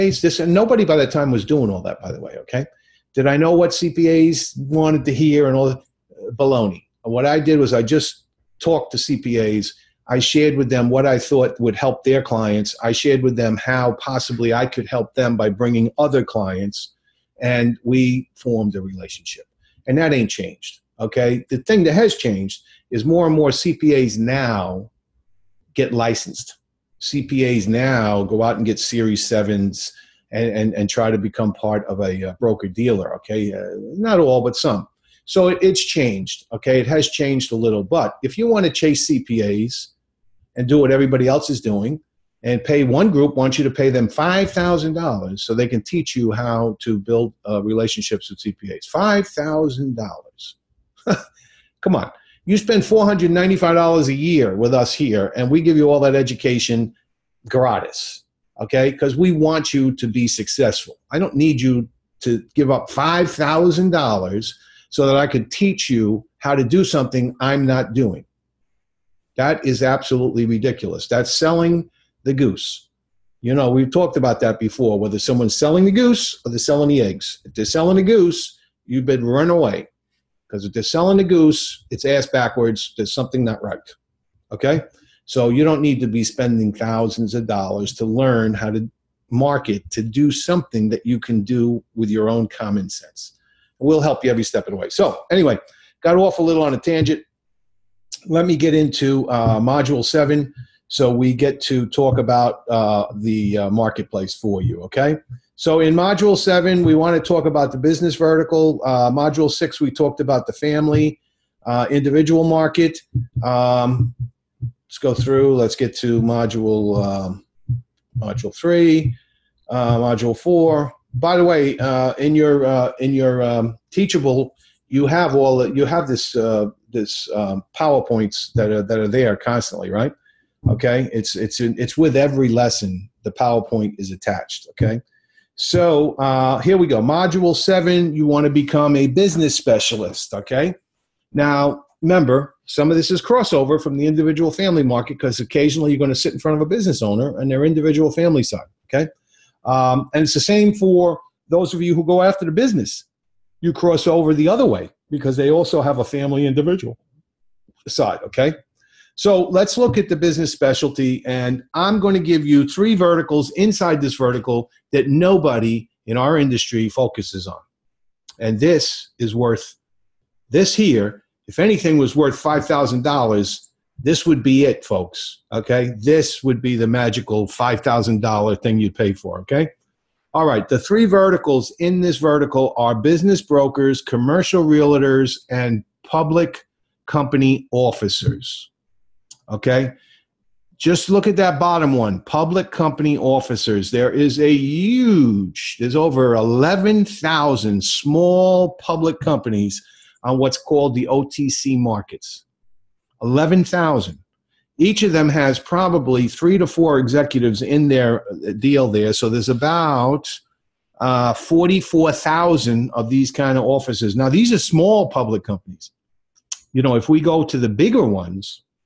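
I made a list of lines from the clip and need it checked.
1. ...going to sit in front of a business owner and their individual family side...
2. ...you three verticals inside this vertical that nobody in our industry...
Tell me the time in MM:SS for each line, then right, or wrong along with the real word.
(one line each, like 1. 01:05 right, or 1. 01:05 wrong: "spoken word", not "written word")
1. 02:25 right
2. 02:42 right.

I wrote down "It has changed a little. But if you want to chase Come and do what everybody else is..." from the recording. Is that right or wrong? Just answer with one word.
wrong.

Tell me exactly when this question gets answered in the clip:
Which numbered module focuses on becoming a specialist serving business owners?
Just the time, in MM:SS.
01:39.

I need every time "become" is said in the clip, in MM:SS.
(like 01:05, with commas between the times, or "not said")
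00:31, 02:18.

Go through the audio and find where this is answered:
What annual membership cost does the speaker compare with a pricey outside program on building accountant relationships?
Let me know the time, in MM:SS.
00:52.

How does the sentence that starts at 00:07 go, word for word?
What I did was I just talked to CPAs.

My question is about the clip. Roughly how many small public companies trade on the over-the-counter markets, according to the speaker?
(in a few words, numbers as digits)
11,000.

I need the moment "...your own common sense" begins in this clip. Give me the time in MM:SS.
01:32.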